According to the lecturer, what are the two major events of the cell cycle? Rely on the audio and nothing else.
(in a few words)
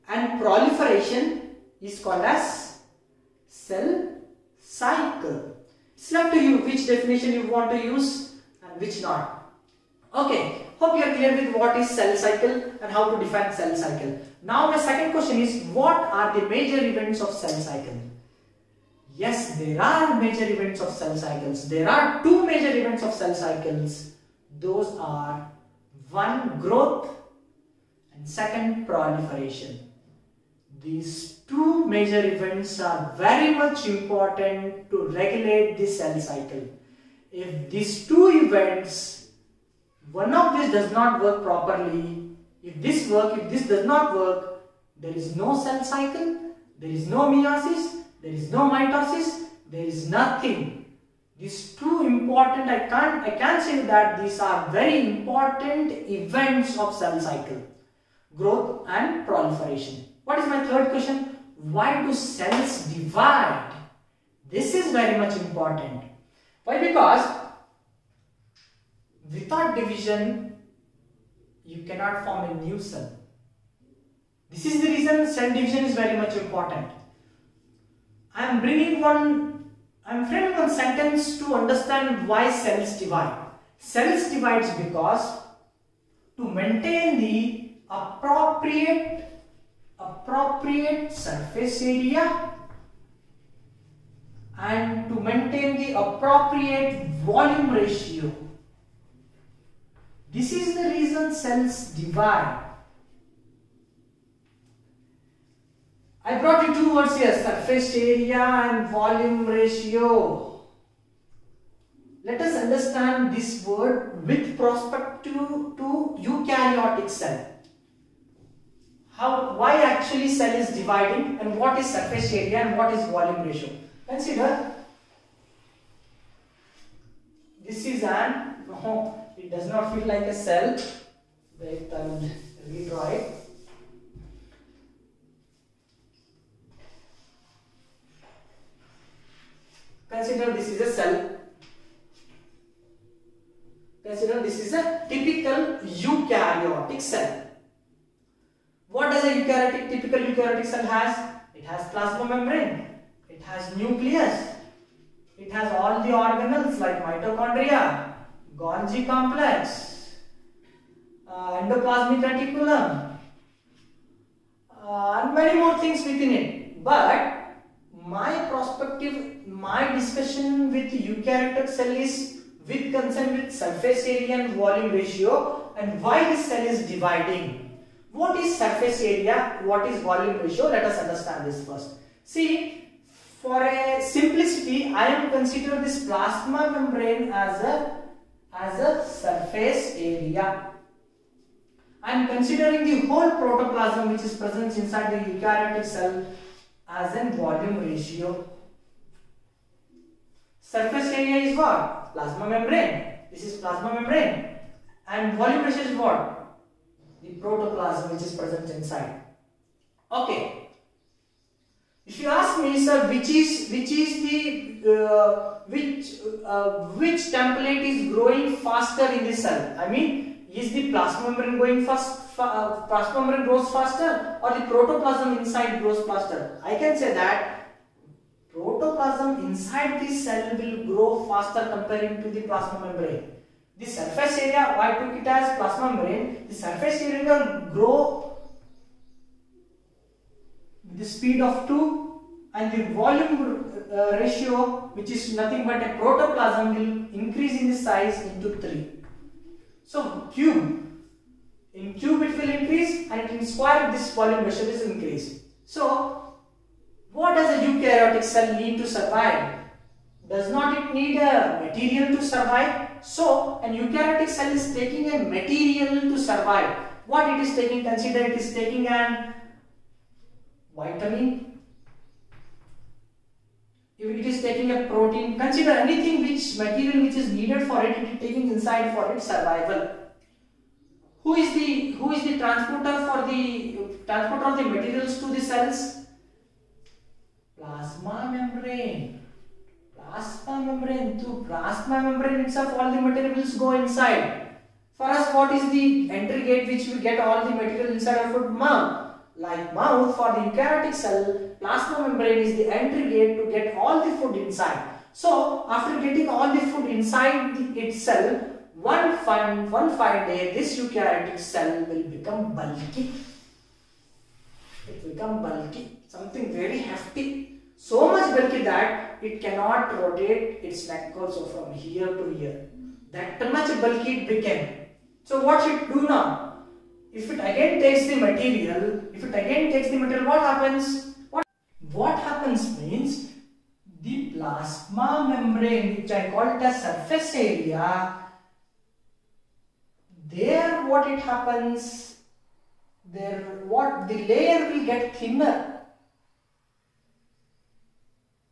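growth and proliferation.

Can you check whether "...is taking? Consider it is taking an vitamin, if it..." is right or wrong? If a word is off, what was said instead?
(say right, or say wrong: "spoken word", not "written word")
right.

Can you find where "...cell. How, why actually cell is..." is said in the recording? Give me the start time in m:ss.
1:57.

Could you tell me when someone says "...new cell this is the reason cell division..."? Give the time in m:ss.
1:12.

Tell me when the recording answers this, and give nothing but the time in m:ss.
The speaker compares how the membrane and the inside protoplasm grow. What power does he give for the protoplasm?
4:08.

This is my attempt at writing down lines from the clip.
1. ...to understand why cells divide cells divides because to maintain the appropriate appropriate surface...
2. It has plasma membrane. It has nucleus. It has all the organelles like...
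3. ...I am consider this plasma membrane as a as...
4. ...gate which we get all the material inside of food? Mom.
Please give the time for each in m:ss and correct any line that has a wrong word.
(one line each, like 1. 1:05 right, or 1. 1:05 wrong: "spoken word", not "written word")
1. 1:21 right
2. 2:31 right
3. 3:04 right
4. 4:56 right.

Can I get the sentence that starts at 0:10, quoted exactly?
Okay, Hope you are clear with what is cell cycle and how to define cell cycle.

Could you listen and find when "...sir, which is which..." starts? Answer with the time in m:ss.
3:32.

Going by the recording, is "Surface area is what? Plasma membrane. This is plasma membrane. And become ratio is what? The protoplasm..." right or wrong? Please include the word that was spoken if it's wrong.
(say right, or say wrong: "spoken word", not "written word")
wrong: "volume", not "become".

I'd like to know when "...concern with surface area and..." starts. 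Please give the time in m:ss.
2:52.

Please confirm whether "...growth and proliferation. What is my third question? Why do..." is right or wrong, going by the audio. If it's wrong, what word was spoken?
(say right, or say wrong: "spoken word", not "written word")
right.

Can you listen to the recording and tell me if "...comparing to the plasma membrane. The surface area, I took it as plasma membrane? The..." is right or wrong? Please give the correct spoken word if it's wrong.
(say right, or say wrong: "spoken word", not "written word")
right.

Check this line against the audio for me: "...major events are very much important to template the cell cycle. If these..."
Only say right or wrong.
wrong.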